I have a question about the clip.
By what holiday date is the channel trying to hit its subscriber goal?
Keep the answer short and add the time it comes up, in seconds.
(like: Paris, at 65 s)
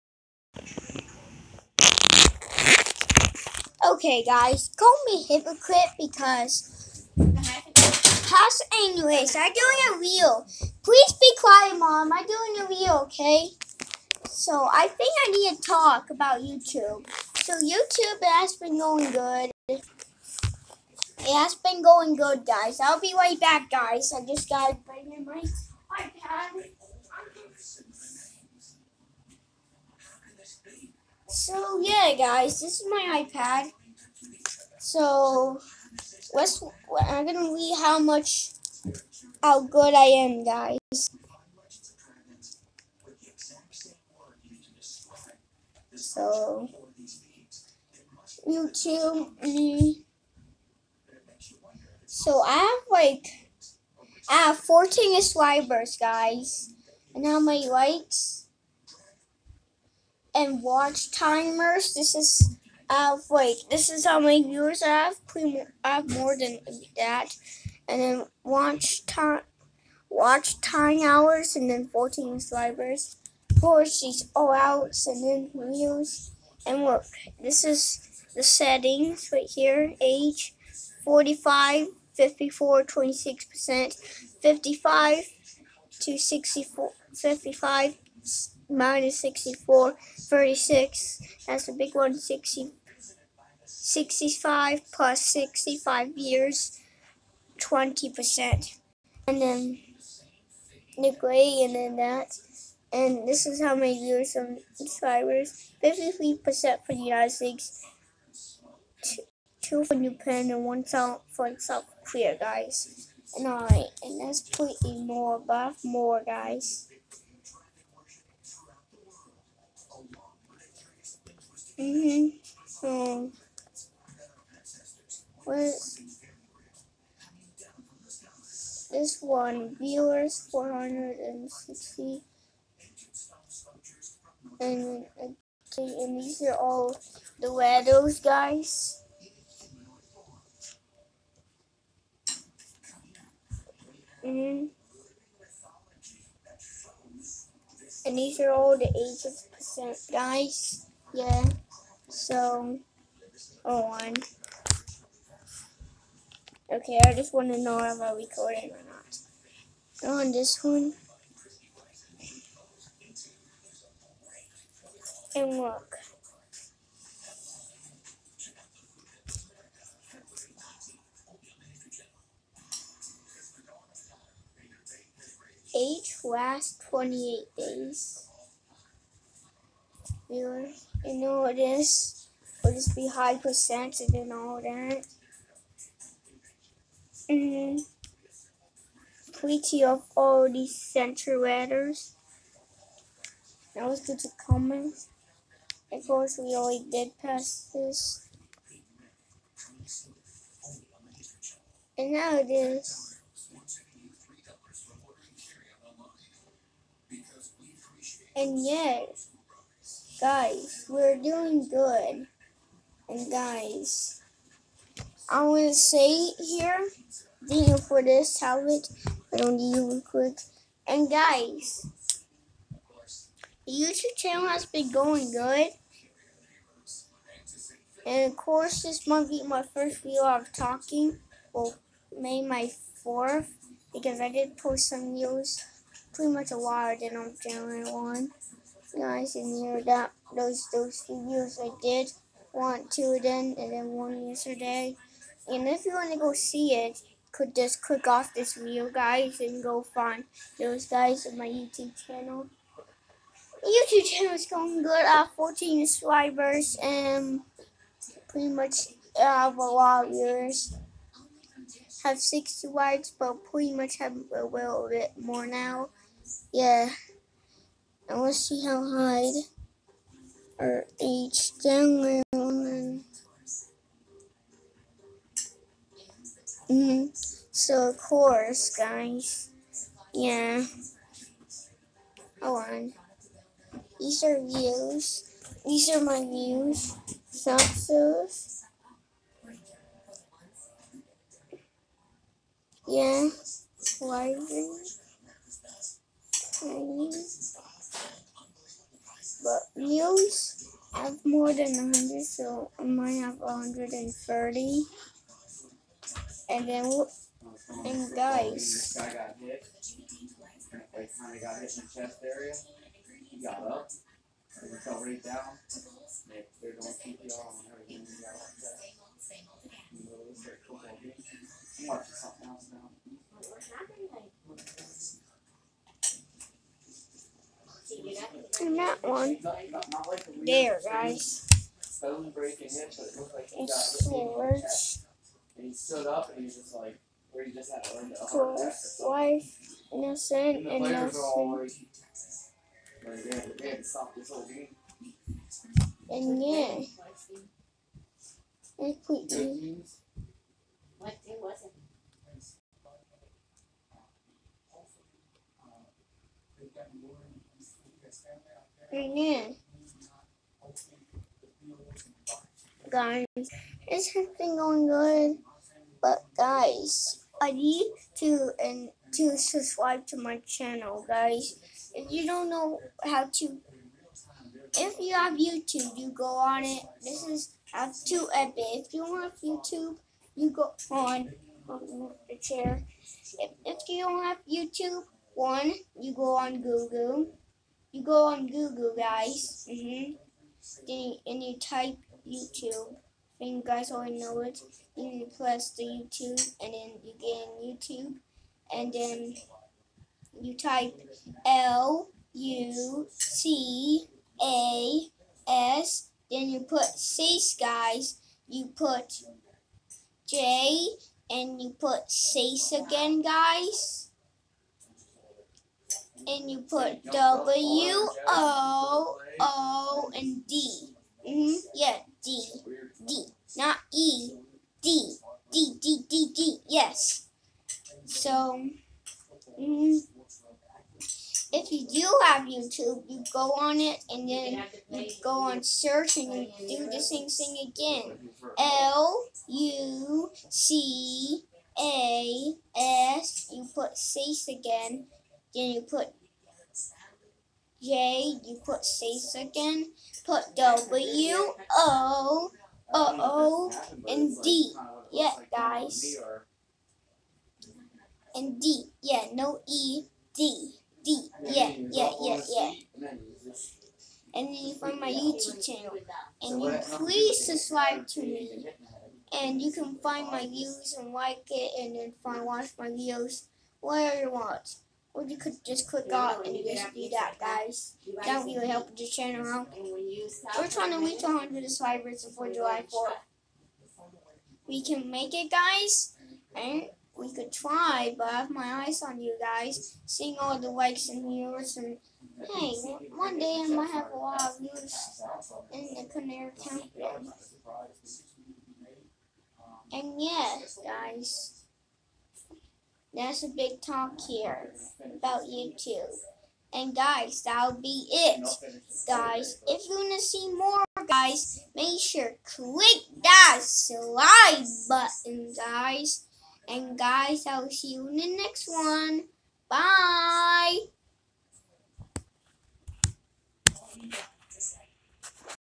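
July 4th, at 482 s.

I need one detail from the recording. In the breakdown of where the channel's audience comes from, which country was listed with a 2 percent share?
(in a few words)
Japan.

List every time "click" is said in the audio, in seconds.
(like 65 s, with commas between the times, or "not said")
247 s, 475 s, 512 s.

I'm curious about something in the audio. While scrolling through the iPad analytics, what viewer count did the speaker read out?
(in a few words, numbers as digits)
460.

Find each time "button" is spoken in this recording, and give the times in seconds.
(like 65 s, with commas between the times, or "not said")
514 s.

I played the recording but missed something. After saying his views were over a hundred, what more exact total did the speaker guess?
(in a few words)
130.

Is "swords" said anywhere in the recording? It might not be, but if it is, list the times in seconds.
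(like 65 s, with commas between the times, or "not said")
333 s.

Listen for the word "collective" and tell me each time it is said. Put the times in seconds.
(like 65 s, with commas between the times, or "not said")
not said.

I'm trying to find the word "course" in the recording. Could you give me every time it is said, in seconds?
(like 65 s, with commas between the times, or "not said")
196 s, 228 s, 277 s.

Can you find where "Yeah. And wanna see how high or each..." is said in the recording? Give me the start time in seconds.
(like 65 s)
266 s.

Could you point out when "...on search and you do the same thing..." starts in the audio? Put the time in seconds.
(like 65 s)
435 s.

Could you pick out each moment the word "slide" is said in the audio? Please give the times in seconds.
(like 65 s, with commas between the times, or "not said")
513 s.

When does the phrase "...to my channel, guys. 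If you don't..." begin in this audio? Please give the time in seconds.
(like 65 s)
370 s.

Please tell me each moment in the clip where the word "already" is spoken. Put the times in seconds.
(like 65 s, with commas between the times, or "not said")
196 s, 393 s.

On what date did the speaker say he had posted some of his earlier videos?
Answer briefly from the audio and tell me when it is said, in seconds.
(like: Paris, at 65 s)
January 1, at 237 s.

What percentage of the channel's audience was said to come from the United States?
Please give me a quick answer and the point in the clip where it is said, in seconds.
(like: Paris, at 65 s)
53%, at 105 s.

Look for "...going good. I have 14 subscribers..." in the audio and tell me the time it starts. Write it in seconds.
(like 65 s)
254 s.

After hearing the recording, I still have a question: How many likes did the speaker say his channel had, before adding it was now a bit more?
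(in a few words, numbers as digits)
60.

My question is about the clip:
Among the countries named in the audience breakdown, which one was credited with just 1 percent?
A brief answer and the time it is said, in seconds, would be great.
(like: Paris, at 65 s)
South Korea, at 111 s.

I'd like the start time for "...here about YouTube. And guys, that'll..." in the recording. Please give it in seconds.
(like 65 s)
504 s.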